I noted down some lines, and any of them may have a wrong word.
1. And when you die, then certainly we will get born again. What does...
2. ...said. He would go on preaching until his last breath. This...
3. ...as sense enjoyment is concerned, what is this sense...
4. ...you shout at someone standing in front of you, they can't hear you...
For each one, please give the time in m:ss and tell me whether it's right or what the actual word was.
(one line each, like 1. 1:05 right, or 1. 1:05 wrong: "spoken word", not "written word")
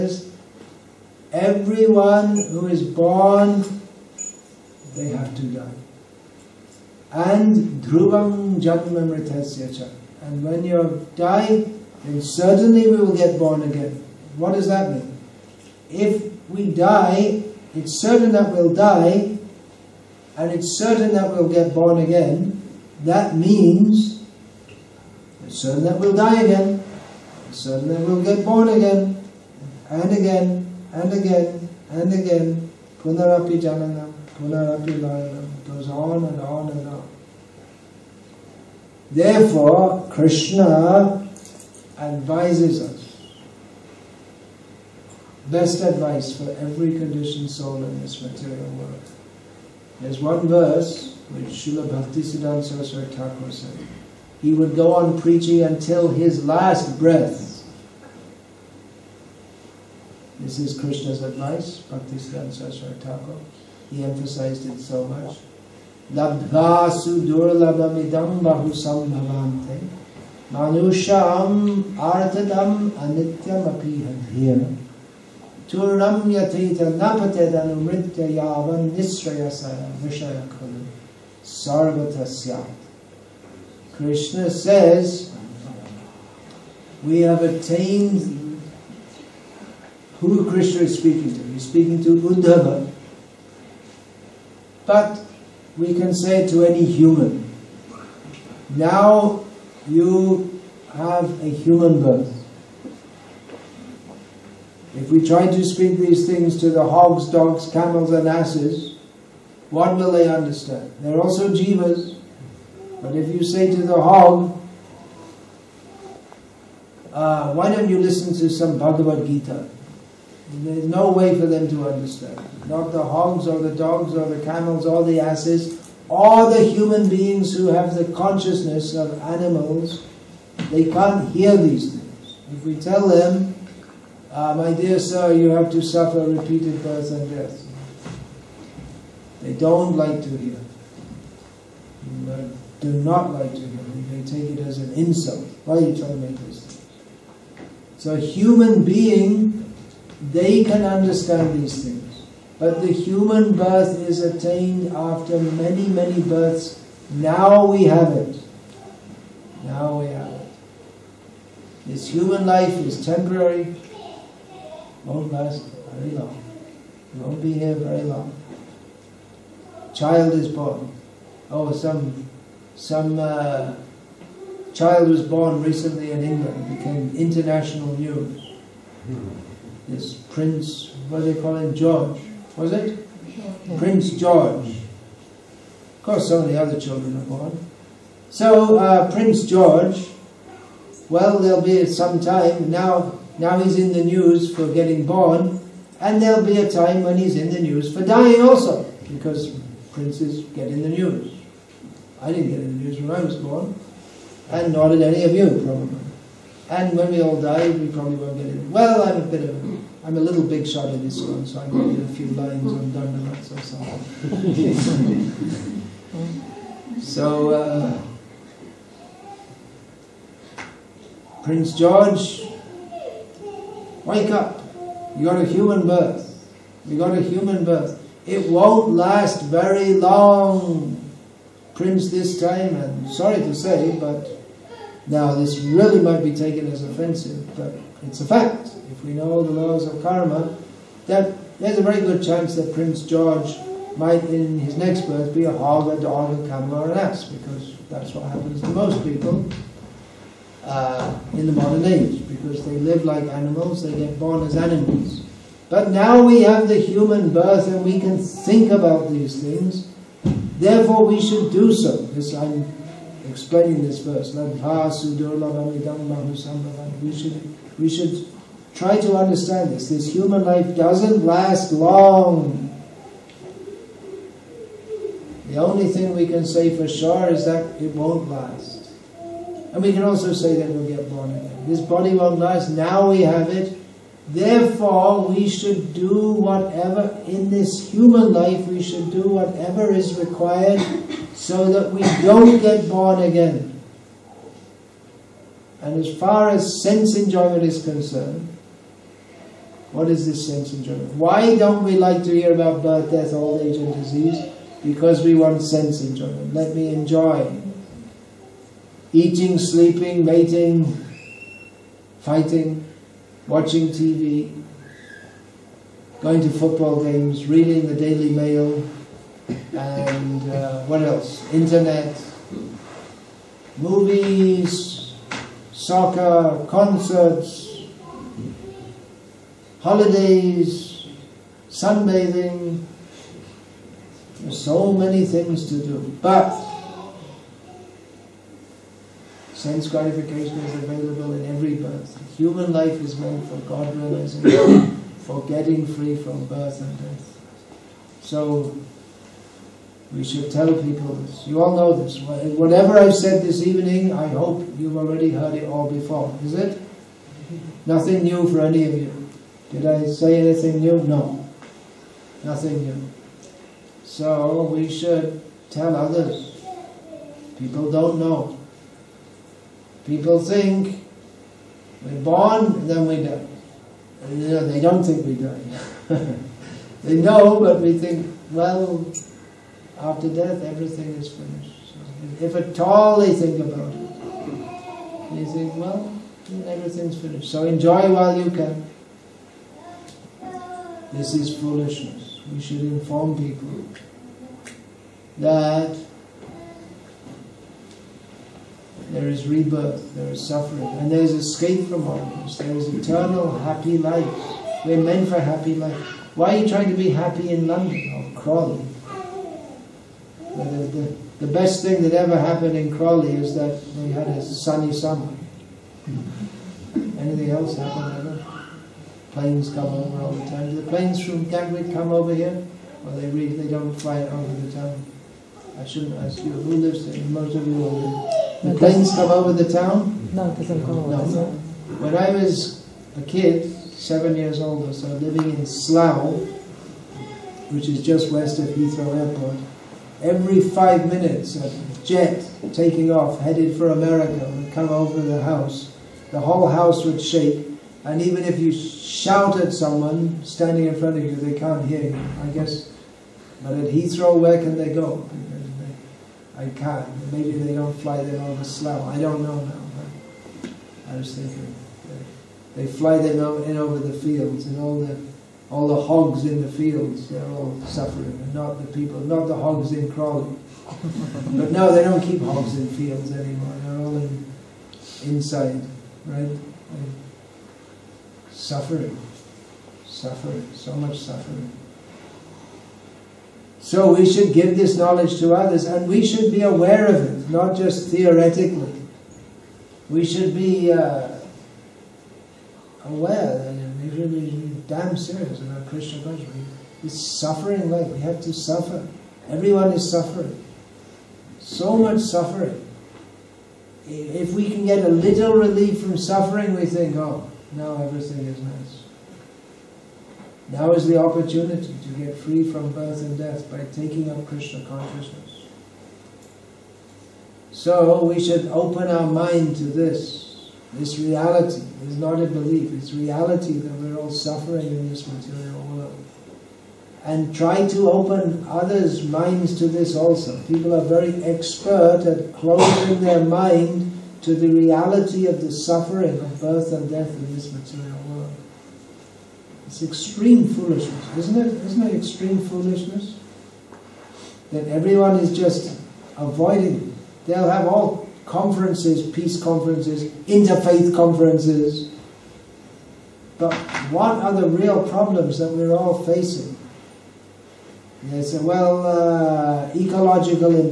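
1. 0:10 right
2. 0:53 right
3. 4:56 right
4. 7:28 right.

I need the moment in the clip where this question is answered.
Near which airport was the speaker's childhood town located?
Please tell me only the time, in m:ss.
7:18.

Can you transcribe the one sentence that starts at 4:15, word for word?
But now we have the human birth and we can think about these things.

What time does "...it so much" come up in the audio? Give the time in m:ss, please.
1:04.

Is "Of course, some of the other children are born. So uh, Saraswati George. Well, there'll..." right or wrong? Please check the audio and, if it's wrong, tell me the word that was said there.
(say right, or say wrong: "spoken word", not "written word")
wrong: "Prince", not "Saraswati".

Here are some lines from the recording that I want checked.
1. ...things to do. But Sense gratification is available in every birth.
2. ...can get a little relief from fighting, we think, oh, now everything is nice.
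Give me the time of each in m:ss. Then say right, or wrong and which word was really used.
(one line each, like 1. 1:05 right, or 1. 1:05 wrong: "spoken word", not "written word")
1. 5:35 right
2. 8:24 wrong: "suffering", not "fighting".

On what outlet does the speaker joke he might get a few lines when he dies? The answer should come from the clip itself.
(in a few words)
Dandavats.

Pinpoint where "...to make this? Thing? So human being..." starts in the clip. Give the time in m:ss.
2:26.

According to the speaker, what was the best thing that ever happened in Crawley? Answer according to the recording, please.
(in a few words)
a sunny summer.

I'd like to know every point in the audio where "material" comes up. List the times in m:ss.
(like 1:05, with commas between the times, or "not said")
0:48, 8:45, 8:57.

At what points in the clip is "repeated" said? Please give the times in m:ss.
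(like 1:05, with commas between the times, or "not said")
2:16.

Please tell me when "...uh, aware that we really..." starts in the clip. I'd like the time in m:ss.
8:10.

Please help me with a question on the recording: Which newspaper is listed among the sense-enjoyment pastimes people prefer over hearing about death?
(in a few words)
Daily Mail.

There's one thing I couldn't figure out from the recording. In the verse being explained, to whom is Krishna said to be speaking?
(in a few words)
Uddhava.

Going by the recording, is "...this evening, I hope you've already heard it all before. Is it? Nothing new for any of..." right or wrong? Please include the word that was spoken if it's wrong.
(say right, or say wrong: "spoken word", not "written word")
right.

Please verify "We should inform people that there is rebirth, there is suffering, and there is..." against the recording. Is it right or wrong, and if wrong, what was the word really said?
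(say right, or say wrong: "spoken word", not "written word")
right.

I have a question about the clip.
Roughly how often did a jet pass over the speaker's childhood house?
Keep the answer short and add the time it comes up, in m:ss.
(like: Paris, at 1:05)
every 5 minutes, at 7:20.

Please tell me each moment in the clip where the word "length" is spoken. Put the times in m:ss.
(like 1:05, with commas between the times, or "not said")
not said.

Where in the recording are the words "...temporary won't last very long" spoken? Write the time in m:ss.
2:43.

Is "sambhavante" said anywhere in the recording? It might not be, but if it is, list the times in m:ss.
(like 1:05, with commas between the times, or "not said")
1:08.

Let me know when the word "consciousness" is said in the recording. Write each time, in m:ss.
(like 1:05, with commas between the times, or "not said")
2:08, 8:16, 8:34.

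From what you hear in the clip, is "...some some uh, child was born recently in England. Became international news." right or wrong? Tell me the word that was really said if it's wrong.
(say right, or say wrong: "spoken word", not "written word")
right.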